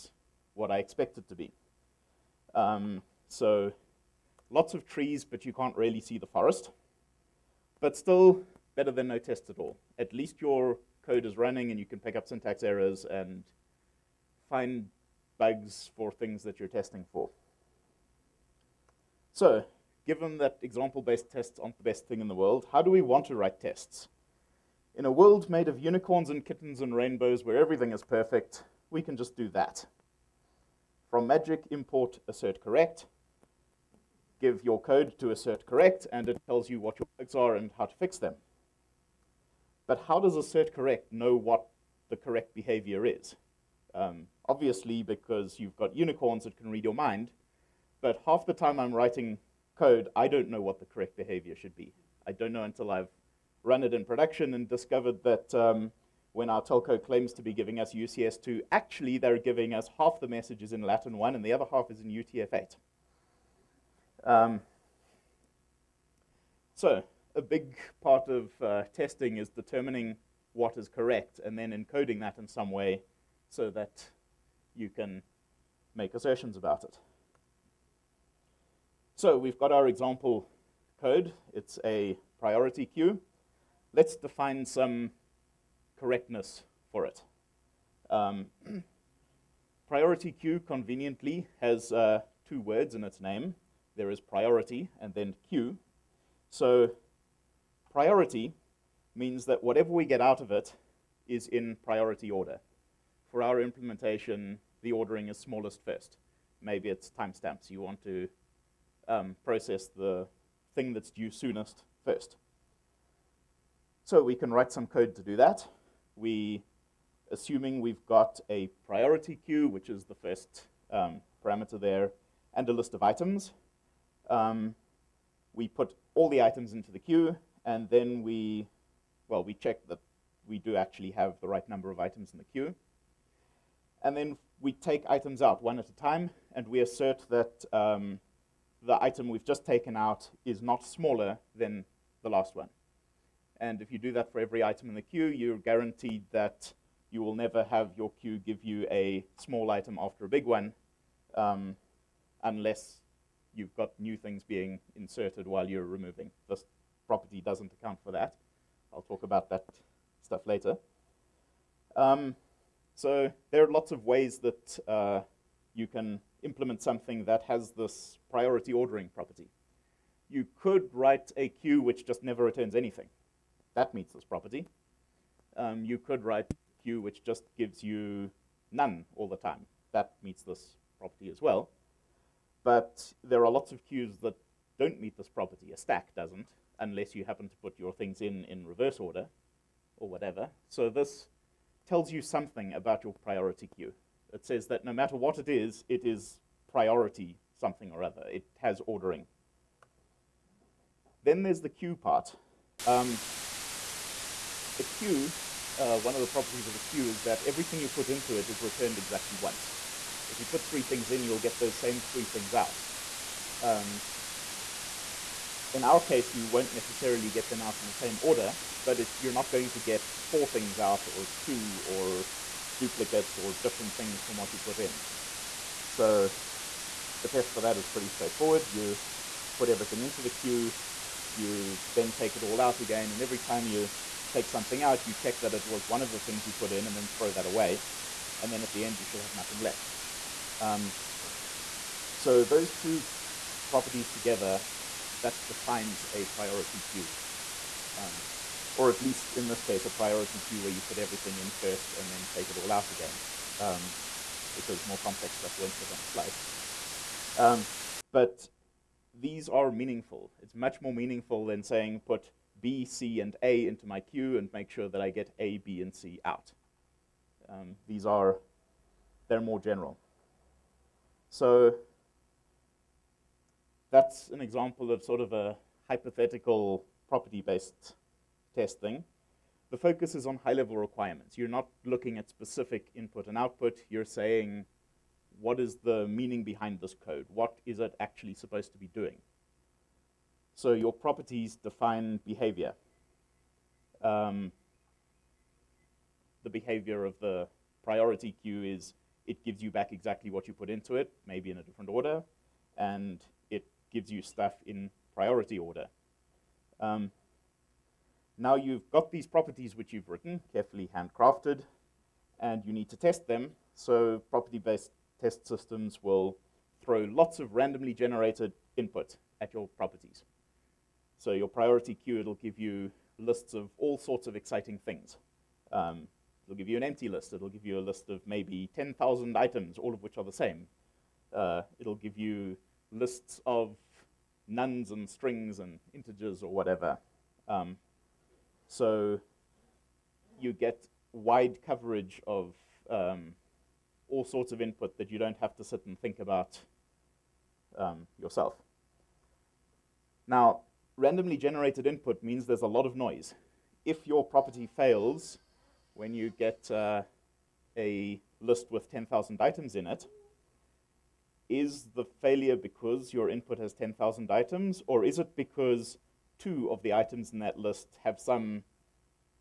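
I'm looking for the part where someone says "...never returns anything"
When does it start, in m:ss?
2:52.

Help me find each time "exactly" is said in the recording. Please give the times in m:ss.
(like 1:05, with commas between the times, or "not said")
3:28, 4:59.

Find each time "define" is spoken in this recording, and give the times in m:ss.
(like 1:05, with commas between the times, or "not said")
1:24, 4:05, 4:51.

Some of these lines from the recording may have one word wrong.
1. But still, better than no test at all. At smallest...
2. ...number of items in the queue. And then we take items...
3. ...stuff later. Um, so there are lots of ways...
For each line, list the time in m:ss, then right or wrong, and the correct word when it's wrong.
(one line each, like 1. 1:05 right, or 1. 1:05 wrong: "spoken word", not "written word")
1. 0:07 wrong: "least", not "smallest"
2. 2:11 right
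3. 2:40 right.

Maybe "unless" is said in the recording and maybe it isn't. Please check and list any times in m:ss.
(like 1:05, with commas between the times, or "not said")
2:32, 3:06.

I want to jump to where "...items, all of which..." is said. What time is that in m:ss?
5:29.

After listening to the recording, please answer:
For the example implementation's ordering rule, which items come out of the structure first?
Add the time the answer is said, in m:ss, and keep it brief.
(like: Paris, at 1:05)
smallest first, at 1:45.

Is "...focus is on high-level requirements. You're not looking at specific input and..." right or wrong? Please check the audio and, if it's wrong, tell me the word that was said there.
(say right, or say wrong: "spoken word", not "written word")
right.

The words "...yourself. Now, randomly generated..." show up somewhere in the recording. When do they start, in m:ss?
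5:48.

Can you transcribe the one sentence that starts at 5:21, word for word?
So your priority queue, it'll give you lists of all sorts of exciting things.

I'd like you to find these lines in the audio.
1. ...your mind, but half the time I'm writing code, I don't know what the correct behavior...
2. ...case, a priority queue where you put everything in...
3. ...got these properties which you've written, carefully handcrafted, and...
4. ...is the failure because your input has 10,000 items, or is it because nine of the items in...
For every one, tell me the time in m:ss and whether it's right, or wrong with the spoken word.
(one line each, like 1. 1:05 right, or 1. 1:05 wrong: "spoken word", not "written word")
1. 0:46 right
2. 4:09 right
3. 5:08 right
4. 6:01 wrong: "two", not "nine".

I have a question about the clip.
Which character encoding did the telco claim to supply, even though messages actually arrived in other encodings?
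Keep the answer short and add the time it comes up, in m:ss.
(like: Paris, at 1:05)
UCS2, at 0:57.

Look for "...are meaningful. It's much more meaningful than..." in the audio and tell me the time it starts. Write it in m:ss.
4:19.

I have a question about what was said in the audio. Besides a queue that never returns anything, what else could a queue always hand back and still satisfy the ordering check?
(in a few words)
None.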